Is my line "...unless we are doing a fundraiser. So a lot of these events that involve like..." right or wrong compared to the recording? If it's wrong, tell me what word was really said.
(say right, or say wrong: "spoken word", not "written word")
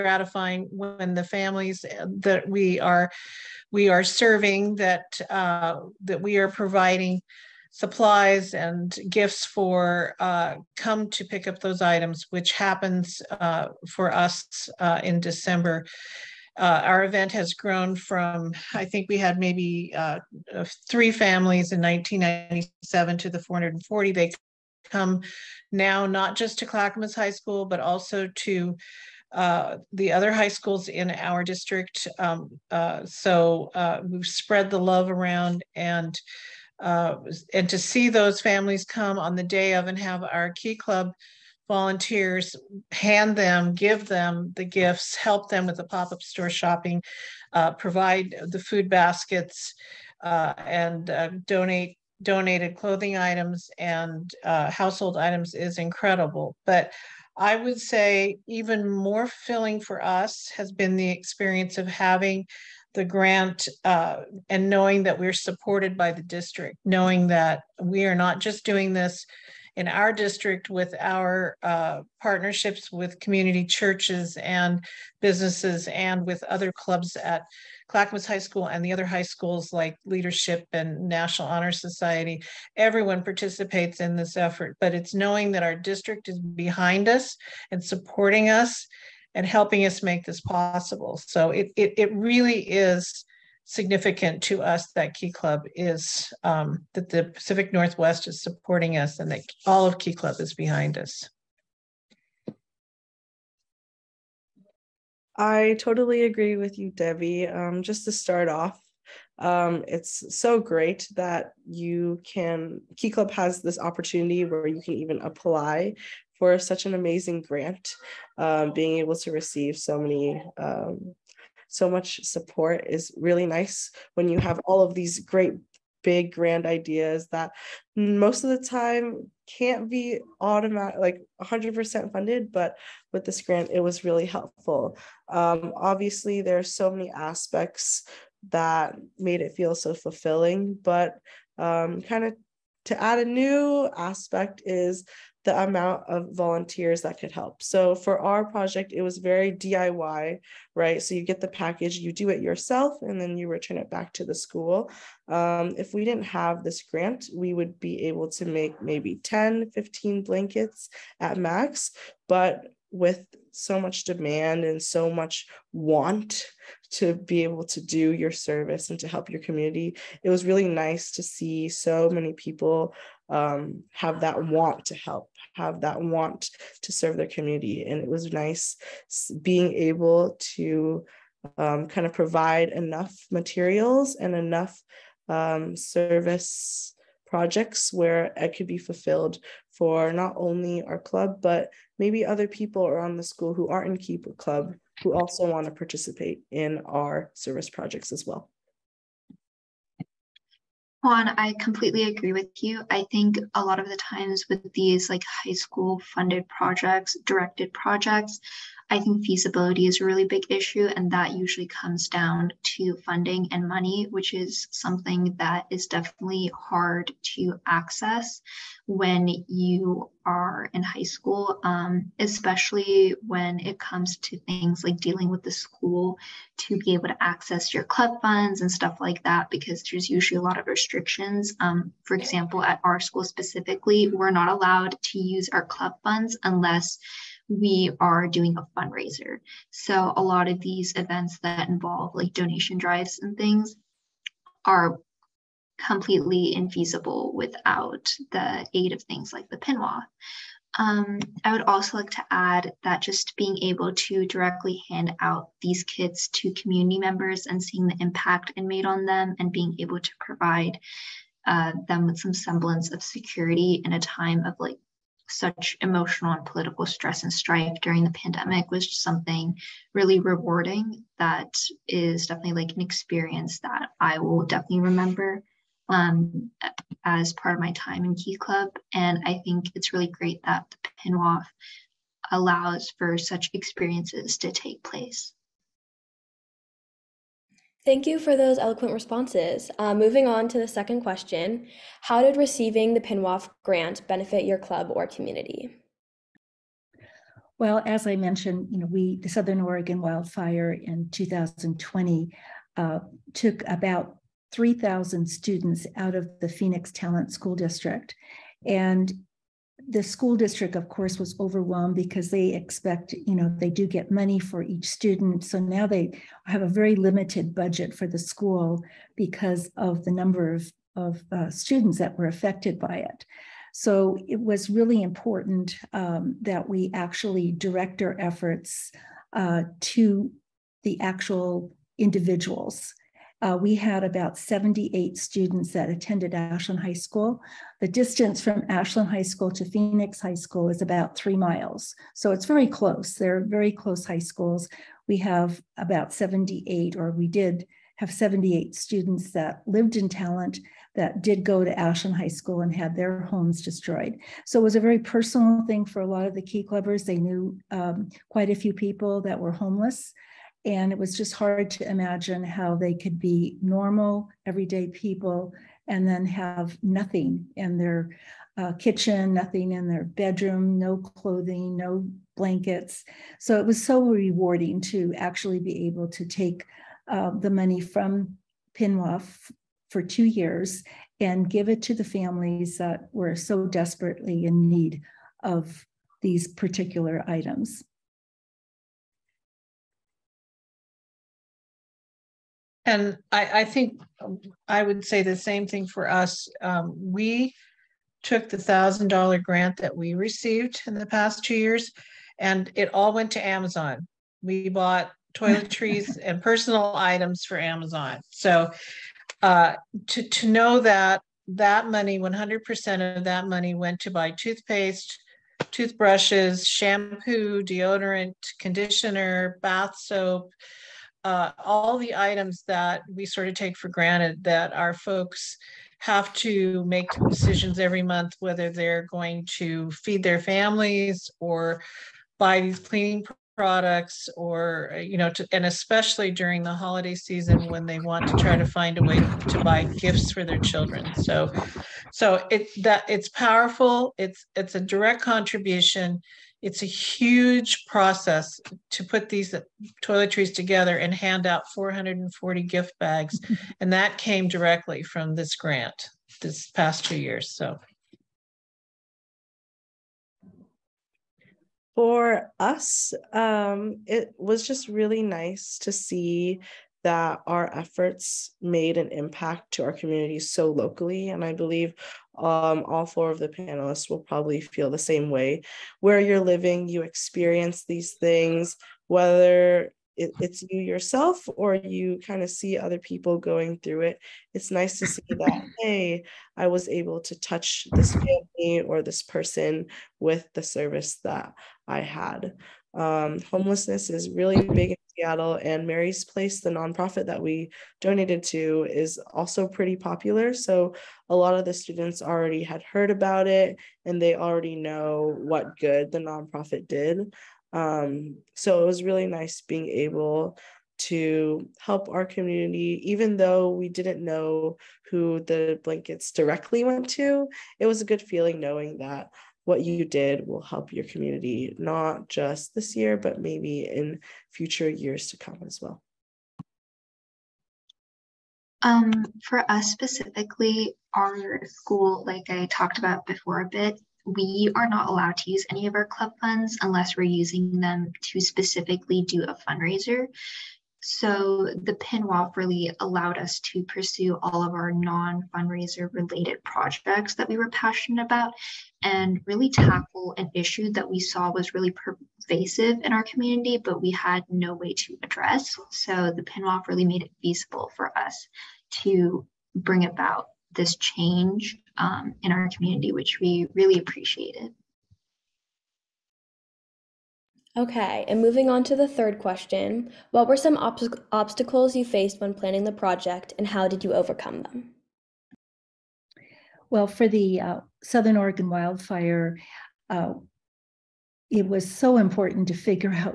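right.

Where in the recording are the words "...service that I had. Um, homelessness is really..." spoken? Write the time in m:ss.
8:10.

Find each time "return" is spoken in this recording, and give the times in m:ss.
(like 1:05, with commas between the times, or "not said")
2:33.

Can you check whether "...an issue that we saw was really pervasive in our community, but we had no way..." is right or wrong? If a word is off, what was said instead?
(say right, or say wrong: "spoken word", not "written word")
right.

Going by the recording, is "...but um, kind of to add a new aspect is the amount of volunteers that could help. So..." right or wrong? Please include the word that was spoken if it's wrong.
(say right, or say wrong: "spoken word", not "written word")
right.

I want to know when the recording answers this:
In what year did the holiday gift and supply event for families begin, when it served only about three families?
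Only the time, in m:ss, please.
0:21.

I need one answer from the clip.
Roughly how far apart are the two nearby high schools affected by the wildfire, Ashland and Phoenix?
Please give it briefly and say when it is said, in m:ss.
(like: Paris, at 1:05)
3 miles, at 5:41.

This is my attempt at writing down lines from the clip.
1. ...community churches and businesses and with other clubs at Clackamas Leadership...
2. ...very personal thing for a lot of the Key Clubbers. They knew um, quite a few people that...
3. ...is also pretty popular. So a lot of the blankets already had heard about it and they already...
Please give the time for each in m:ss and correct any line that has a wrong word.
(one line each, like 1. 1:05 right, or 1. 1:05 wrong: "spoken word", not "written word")
1. 1:13 wrong: "High", not "Leadership"
2. 5:54 right
3. 8:18 wrong: "students", not "blankets".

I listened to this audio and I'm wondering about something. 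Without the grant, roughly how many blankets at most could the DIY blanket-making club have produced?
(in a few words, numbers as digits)
10 to 15.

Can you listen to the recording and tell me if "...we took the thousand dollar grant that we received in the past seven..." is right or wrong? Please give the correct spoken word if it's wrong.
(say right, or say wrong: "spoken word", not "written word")
wrong: "two", not "seven".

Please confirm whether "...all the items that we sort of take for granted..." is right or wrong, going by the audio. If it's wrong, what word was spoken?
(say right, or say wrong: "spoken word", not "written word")
right.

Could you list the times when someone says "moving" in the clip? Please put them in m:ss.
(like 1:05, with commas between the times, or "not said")
4:49, 9:28.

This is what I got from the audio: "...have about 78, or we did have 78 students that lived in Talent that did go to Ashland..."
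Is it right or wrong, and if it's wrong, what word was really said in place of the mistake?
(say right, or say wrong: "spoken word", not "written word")
right.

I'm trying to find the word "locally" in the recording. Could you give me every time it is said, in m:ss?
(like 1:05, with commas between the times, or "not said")
7:50.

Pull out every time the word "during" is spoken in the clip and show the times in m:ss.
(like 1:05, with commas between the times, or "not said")
4:27, 7:16.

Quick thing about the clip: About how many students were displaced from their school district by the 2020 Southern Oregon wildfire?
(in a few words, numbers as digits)
3,000.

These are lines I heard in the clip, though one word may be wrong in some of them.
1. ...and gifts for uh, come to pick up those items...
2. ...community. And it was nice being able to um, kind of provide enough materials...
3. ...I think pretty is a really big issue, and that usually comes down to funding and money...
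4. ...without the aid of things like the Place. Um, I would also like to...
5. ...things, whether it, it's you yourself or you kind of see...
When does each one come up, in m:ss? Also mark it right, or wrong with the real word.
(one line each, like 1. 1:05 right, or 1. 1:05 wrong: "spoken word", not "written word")
1. 0:08 right
2. 2:57 right
3. 3:28 wrong: "feasibility", not "pretty"
4. 4:07 wrong: "PNWOF", not "Place"
5. 7:58 right.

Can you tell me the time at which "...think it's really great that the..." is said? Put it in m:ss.
4:39.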